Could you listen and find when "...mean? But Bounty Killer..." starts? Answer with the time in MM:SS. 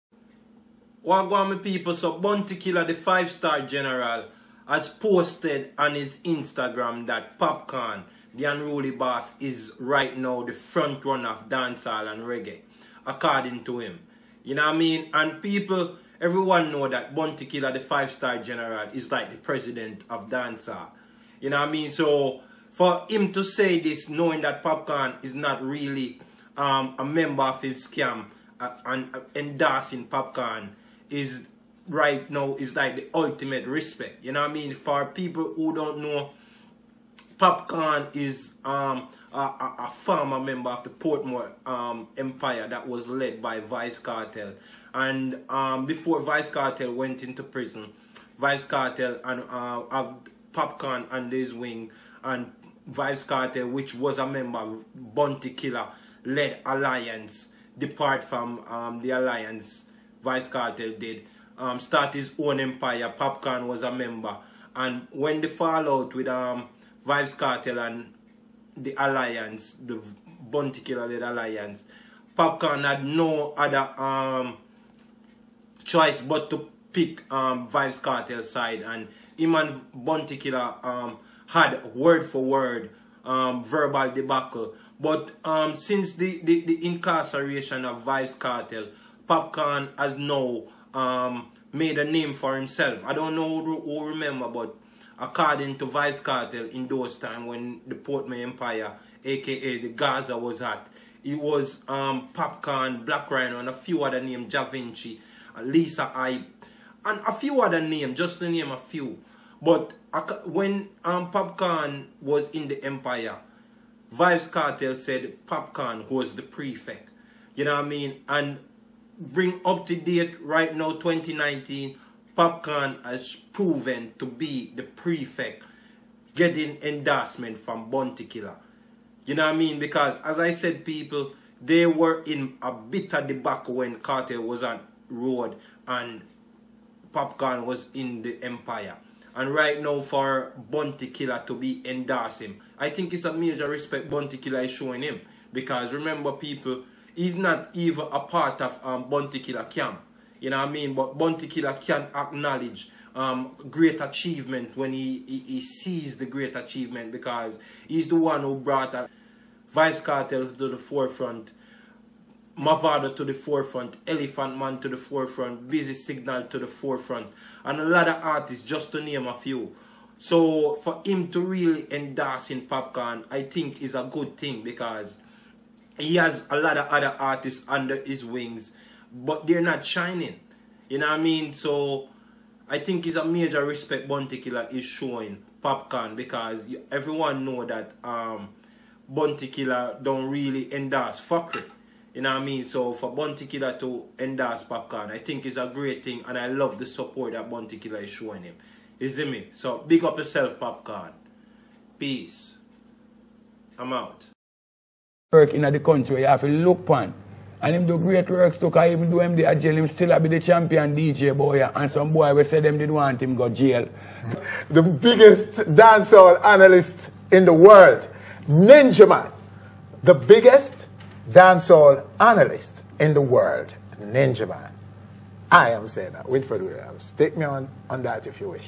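02:30.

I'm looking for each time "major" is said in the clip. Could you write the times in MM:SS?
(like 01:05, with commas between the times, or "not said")
02:23, 03:03.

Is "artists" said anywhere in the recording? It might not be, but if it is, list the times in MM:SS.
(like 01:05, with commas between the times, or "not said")
02:48, 02:57.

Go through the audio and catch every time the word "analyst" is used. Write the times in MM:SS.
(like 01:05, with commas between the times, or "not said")
03:36, 03:42.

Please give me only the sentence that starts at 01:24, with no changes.
But um, since the, the, the incarceration of Vybz Kartel, Popcaan has now um, made a name for himself.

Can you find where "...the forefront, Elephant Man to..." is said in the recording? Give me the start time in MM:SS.
02:43.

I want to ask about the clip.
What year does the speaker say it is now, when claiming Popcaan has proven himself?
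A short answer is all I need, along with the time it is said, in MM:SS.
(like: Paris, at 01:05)
2019, at 02:00.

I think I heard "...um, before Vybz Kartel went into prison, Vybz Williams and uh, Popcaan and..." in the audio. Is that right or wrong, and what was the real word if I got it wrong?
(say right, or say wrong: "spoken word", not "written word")
wrong: "Kartel", not "Williams".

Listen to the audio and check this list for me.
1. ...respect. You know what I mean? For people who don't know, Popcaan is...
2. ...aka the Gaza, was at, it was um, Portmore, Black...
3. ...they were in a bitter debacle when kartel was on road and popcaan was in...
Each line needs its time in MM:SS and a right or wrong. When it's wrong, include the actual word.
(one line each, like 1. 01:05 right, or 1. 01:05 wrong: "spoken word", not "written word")
1. 00:33 right
2. 01:39 wrong: "Popcaan", not "Portmore"
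3. 02:11 right.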